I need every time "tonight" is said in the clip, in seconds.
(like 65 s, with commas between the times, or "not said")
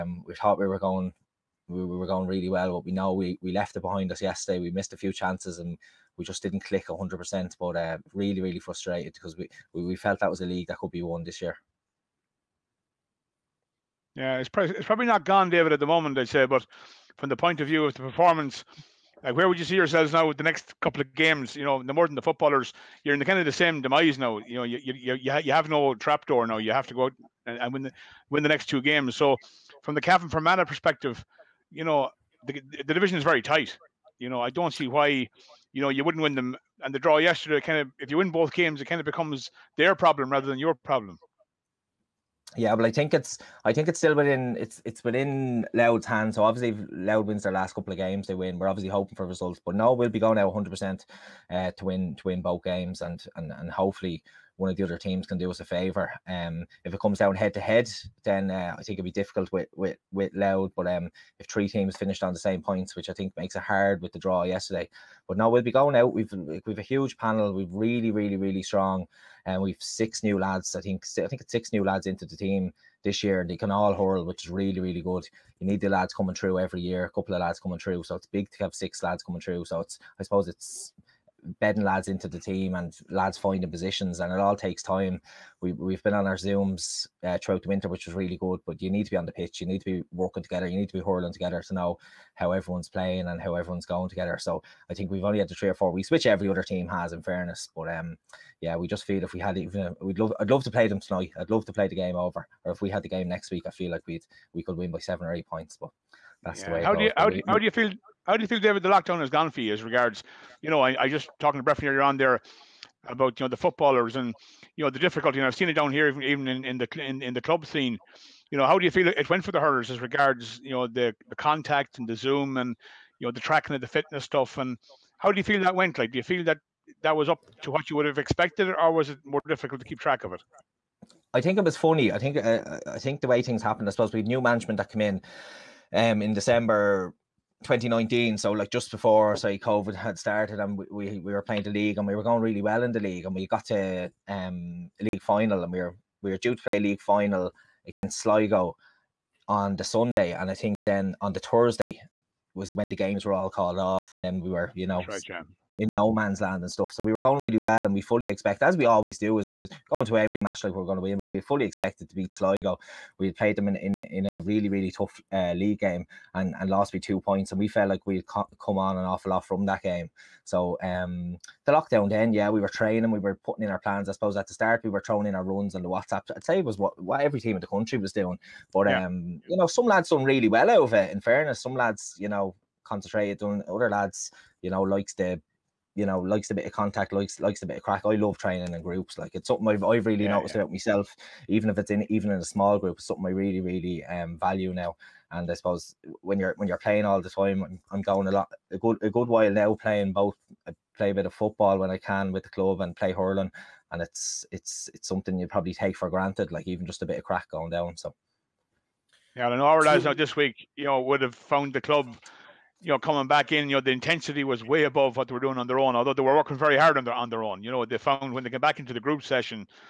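101 s.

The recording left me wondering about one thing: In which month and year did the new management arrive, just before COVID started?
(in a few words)
December 2019.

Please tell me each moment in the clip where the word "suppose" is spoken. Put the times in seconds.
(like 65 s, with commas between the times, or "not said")
80 s, 133 s, 174 s, 195 s.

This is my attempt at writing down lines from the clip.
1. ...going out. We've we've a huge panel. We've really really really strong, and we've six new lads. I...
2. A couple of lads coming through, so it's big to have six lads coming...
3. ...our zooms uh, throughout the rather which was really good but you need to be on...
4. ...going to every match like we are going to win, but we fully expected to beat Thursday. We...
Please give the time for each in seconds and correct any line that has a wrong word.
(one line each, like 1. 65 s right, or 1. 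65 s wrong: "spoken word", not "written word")
1. 65 s right
2. 77 s right
3. 86 s wrong: "winter", not "rather"
4. 159 s wrong: "Sligo", not "Thursday".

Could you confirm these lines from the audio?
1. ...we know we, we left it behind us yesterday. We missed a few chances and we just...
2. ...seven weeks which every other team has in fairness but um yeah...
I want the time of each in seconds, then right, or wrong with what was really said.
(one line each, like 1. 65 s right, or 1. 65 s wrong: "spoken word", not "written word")
1. 2 s right
2. 95 s wrong: "four", not "seven".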